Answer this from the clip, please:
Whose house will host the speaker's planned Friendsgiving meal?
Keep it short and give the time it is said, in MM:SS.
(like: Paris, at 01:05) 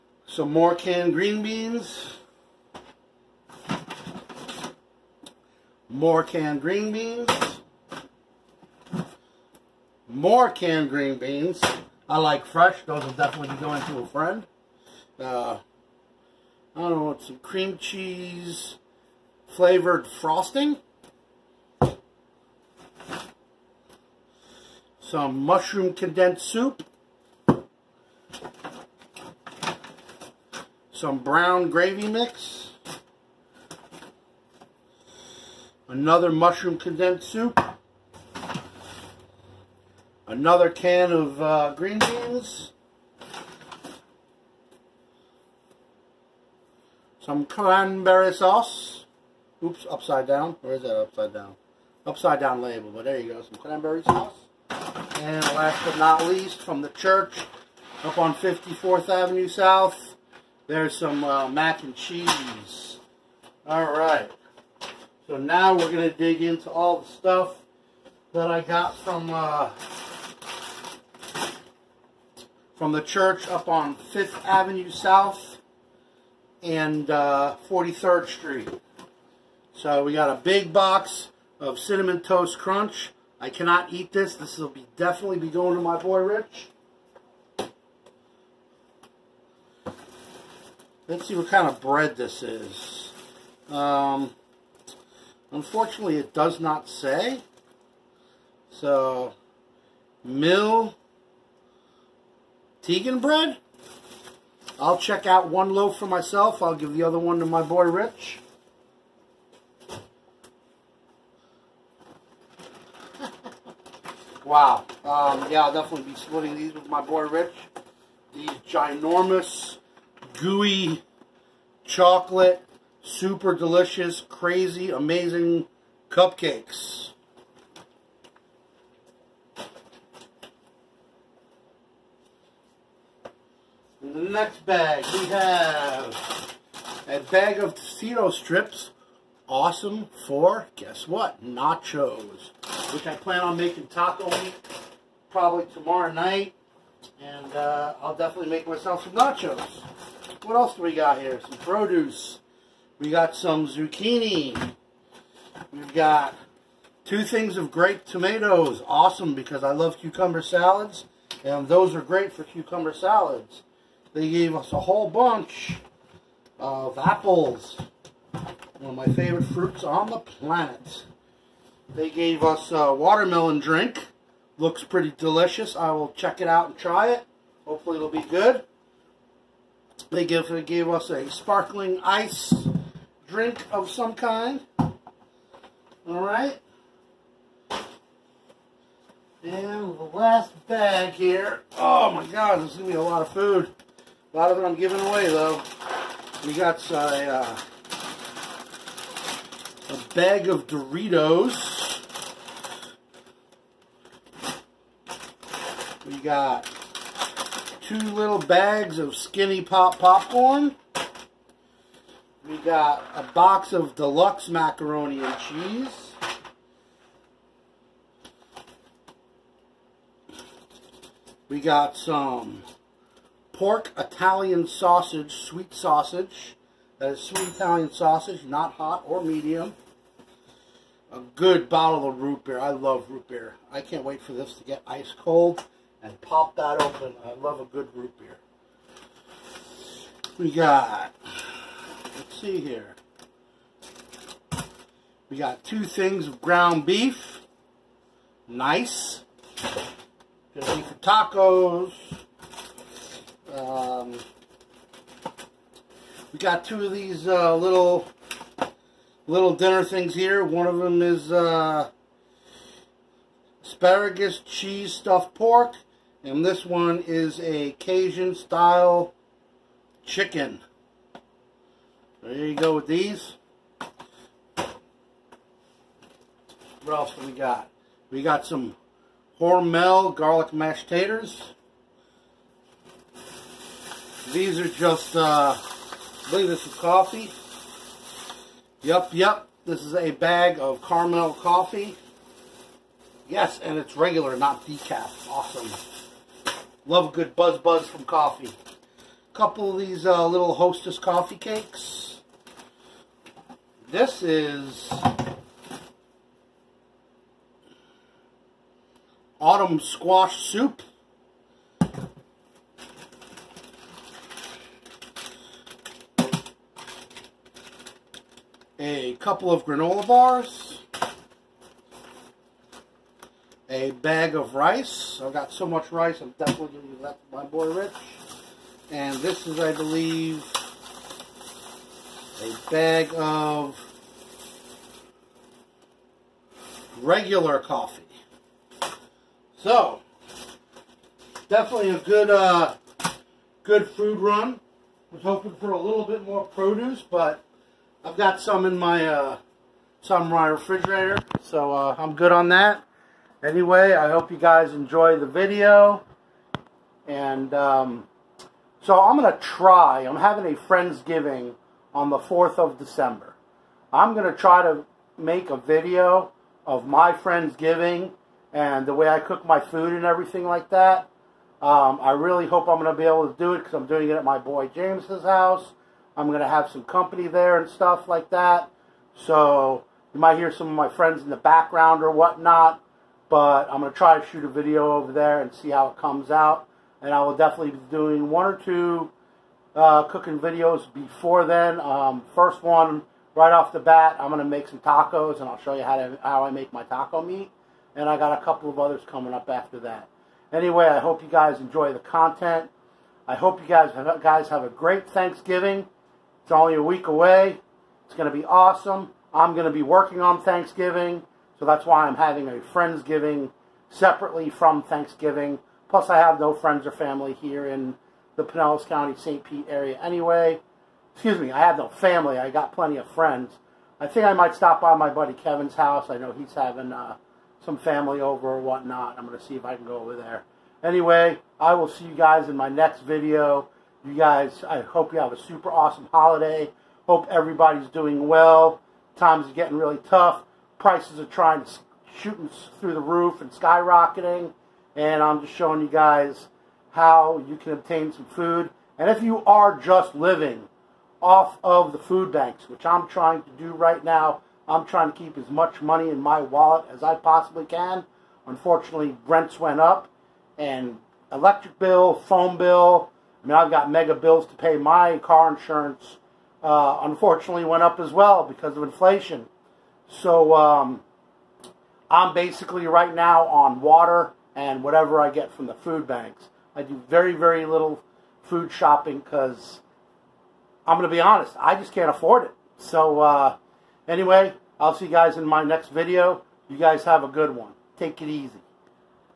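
James, at 06:14.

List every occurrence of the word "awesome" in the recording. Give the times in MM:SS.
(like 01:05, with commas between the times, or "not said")
02:19, 02:38, 04:55, 06:48, 07:15.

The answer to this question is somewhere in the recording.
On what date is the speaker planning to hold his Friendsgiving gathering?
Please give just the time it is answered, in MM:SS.
06:02.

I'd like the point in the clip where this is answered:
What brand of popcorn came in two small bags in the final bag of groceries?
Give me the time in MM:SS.
03:29.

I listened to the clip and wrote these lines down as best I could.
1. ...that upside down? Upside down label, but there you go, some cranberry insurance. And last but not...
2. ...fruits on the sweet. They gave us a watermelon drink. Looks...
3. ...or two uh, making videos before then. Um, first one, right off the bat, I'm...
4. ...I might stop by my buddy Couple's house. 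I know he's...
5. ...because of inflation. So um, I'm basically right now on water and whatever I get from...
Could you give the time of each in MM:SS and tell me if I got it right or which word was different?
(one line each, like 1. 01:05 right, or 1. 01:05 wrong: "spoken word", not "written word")
1. 00:50 wrong: "sauce", not "insurance"
2. 02:49 wrong: "planet", not "sweet"
3. 06:28 wrong: "cooking", not "making"
4. 07:04 wrong: "Kevin", not "Couple"
5. 07:48 right.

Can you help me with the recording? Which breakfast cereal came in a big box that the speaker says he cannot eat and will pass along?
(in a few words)
Cinnamon Toast Crunch.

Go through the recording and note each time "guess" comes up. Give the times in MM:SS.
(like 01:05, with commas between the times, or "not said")
02:20.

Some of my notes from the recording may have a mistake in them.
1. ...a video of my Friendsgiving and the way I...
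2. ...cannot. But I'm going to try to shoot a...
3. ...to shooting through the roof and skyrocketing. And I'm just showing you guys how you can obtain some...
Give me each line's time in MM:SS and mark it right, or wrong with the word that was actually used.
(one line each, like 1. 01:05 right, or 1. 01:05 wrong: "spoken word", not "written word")
1. 06:05 right
2. 06:22 wrong: "whatnot", not "cannot"
3. 07:21 right.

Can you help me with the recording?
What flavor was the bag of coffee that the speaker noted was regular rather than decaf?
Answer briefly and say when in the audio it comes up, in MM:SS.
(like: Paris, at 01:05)
Carmel, at 04:50.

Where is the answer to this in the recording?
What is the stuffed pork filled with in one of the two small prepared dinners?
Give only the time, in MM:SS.
04:23.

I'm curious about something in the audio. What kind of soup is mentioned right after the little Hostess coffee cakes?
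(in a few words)
Autumn squash.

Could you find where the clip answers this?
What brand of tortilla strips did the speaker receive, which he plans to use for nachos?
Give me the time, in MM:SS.
02:17.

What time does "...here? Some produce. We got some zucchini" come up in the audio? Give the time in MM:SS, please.
02:31.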